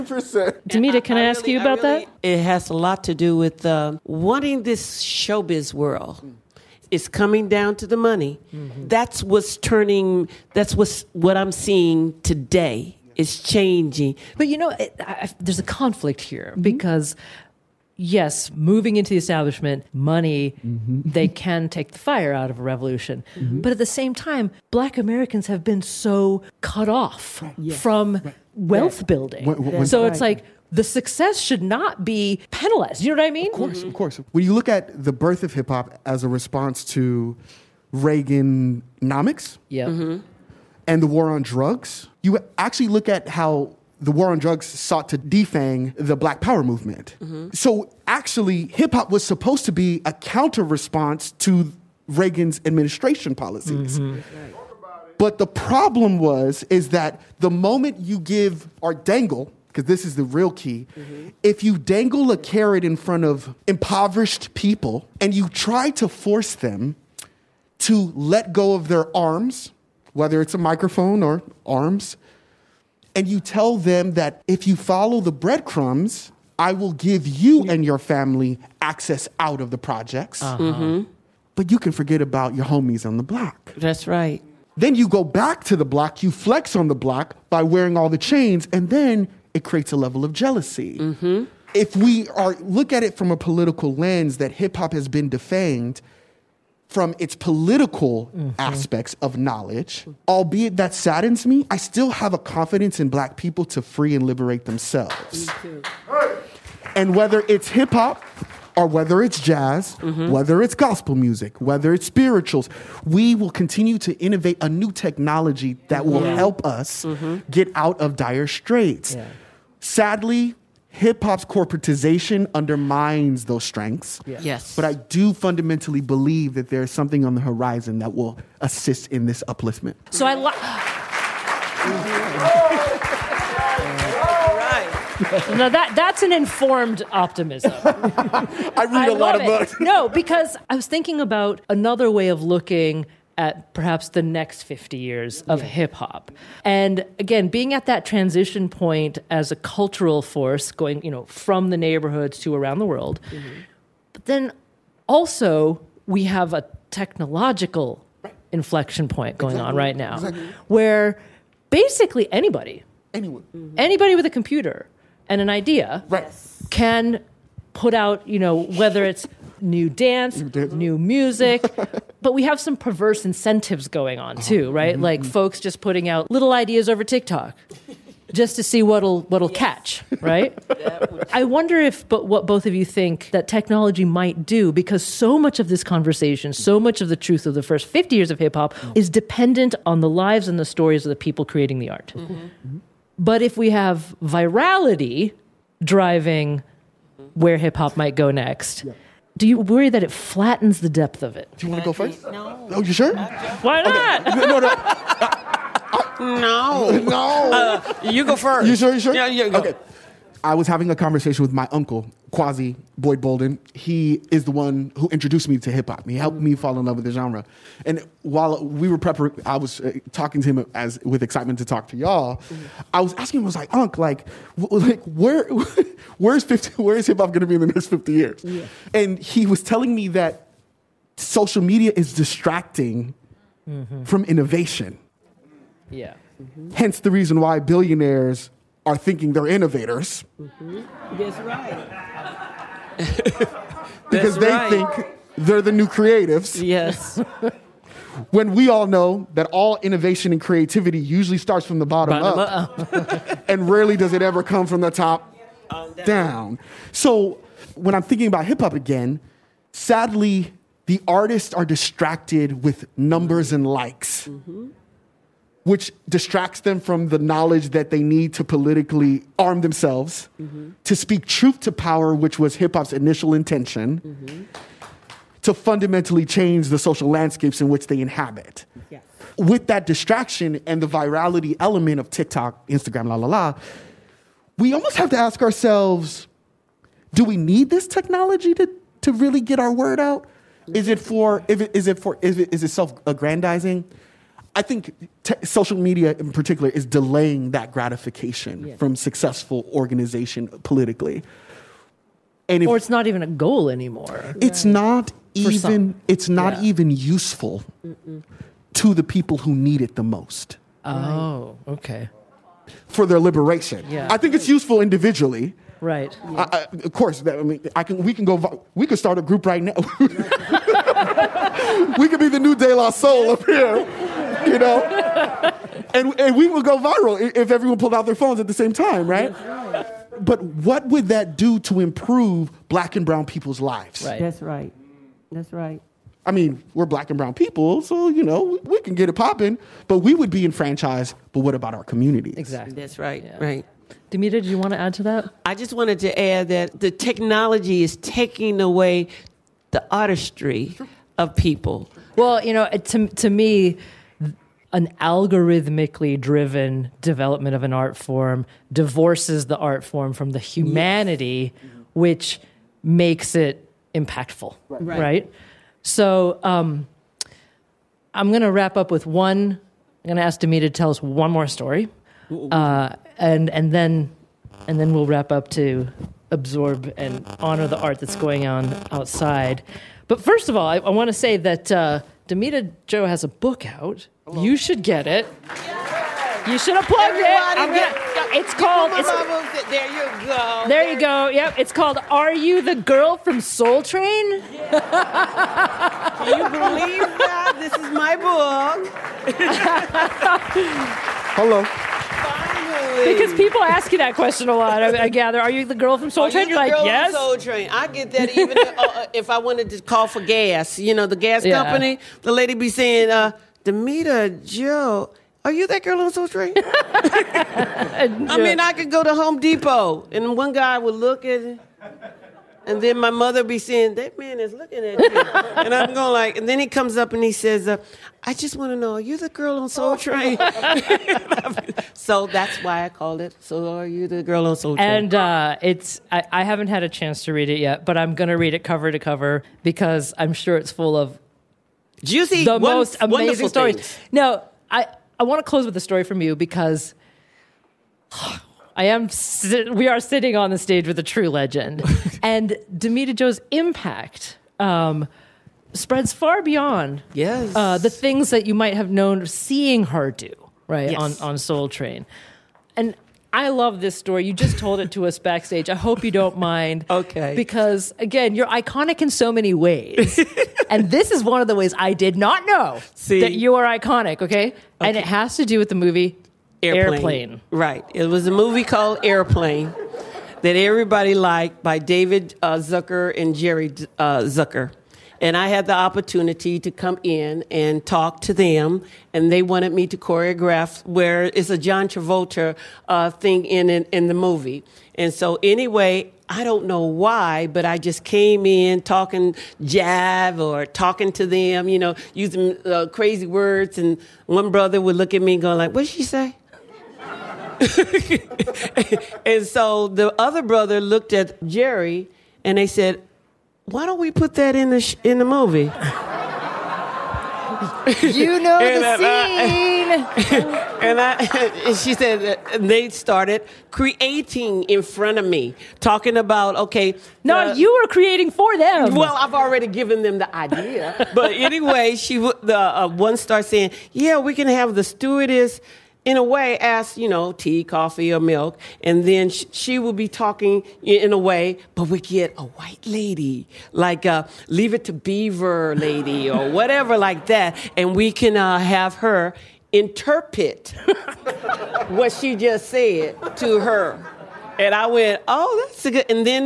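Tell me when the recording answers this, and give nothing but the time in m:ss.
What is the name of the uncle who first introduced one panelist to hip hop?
3:32.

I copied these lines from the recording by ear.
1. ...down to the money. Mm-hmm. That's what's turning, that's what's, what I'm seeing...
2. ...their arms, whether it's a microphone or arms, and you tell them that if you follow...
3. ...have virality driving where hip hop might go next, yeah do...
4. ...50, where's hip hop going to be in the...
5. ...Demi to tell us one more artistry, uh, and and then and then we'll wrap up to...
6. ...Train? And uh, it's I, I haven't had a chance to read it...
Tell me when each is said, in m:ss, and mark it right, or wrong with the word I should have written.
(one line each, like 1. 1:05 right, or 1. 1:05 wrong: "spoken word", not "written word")
1. 0:07 right
2. 1:08 right
3. 3:13 right
4. 3:46 right
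5. 6:10 wrong: "story", not "artistry"
6. 7:14 right.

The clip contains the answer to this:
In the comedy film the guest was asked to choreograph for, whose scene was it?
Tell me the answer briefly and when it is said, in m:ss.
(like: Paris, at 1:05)
John Travolta, at 8:11.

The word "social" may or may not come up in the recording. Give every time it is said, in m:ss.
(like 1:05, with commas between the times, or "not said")
3:51, 4:36, 4:55.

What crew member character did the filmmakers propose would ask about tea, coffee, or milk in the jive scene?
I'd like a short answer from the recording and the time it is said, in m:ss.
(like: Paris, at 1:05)
The stewardess, at 8:54.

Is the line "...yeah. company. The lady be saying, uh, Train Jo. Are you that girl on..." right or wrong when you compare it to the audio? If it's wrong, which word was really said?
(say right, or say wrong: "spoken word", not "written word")
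wrong: "Damita", not "Train".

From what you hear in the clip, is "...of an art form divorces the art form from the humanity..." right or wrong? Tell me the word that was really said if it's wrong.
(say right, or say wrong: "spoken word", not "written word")
right.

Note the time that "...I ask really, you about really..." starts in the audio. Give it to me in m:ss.
0:01.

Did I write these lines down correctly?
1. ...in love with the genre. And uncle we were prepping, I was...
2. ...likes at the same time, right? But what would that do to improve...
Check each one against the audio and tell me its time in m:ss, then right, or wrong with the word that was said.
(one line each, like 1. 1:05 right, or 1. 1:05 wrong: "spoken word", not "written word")
1. 3:36 wrong: "while", not "uncle"
2. 5:28 wrong: "phones", not "likes".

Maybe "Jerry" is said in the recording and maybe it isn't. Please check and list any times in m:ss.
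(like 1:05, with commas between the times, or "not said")
8:03, 8:31.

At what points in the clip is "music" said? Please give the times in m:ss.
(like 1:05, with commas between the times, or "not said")
1:51, 2:50.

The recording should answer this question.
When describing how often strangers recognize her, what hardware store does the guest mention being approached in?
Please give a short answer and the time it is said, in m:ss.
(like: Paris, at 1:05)
Home Depot, at 6:59.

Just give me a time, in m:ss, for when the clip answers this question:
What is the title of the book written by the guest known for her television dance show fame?
6:32.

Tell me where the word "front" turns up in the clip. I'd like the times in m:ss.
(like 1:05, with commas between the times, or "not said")
1:02, 8:44.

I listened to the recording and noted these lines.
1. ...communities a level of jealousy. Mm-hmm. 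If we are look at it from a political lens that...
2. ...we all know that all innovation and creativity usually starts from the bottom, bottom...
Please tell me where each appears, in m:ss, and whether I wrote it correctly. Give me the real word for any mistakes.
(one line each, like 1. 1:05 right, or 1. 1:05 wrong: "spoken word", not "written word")
1. 1:29 wrong: "creates", not "communities"
2. 4:08 right.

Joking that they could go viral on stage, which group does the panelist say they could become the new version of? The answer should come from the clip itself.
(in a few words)
De La Soul.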